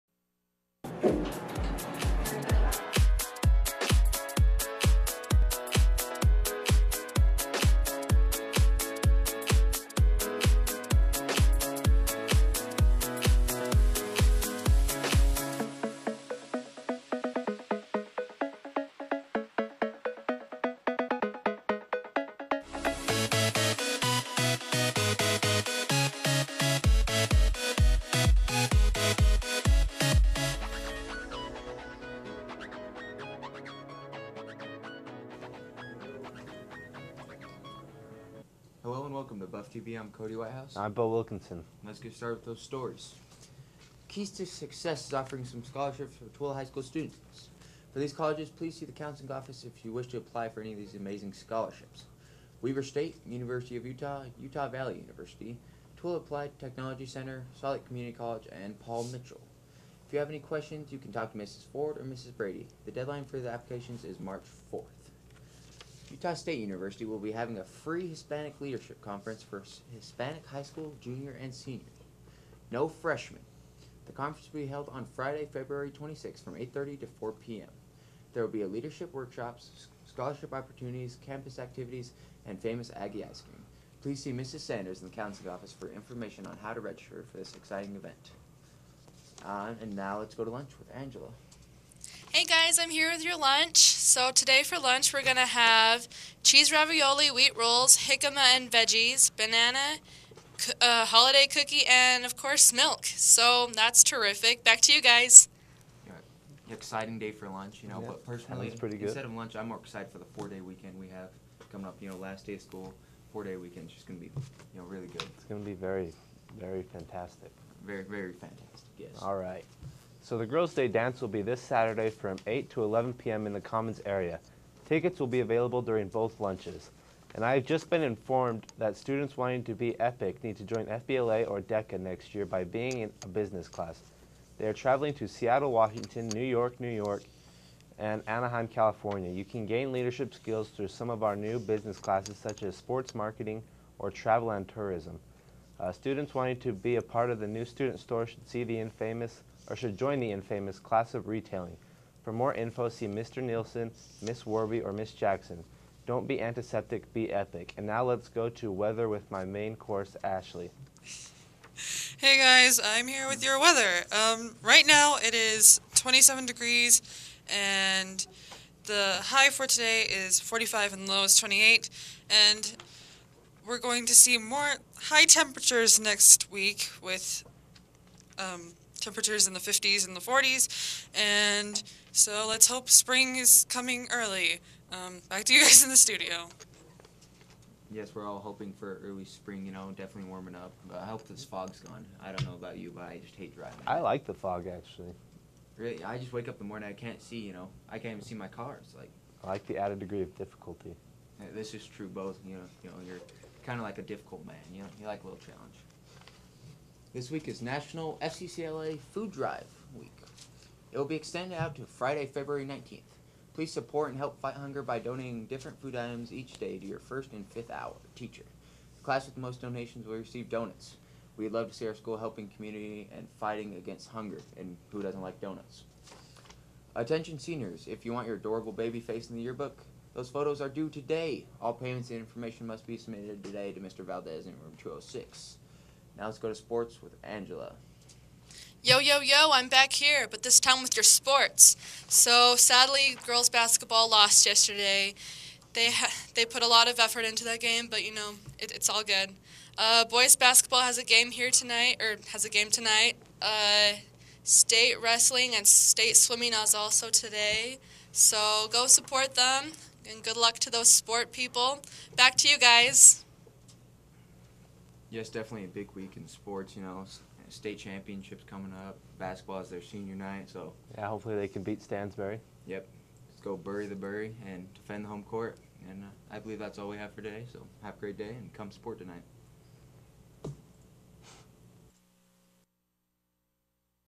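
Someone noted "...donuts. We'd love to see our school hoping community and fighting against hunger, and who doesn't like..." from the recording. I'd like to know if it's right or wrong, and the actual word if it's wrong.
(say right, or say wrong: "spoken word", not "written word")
wrong: "helping", not "hoping".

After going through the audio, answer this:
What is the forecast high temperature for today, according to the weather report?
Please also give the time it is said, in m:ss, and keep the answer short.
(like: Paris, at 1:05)
45, at 2:50.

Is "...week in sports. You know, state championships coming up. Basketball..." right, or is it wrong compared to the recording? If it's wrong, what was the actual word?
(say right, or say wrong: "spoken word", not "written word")
right.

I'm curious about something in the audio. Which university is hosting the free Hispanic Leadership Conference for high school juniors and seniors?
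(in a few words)
Utah State University.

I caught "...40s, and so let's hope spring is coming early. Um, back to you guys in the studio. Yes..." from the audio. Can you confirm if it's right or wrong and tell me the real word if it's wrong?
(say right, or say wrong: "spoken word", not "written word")
right.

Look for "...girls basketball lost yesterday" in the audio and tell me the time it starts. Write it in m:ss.
4:03.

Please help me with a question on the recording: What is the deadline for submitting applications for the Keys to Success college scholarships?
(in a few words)
March 4th.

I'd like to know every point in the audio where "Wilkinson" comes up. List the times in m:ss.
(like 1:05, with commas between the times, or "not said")
0:41.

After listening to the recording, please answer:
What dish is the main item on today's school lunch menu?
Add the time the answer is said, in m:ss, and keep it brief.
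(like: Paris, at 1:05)
Cheese ravioli, at 1:36.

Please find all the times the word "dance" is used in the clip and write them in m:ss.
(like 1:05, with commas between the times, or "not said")
2:00.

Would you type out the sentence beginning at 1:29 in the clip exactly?
Uh, and now let's go to lunch with Angela.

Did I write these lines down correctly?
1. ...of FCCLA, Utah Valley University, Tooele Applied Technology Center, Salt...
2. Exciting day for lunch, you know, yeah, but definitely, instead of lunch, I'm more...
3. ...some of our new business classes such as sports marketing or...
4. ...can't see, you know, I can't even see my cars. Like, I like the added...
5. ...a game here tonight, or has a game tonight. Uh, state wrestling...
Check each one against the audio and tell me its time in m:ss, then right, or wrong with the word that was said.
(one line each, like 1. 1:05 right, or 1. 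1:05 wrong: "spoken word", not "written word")
1. 0:53 wrong: "Utah", not "FCCLA"
2. 1:46 wrong: "personally", not "definitely"
3. 2:20 right
4. 3:16 right
5. 4:10 right.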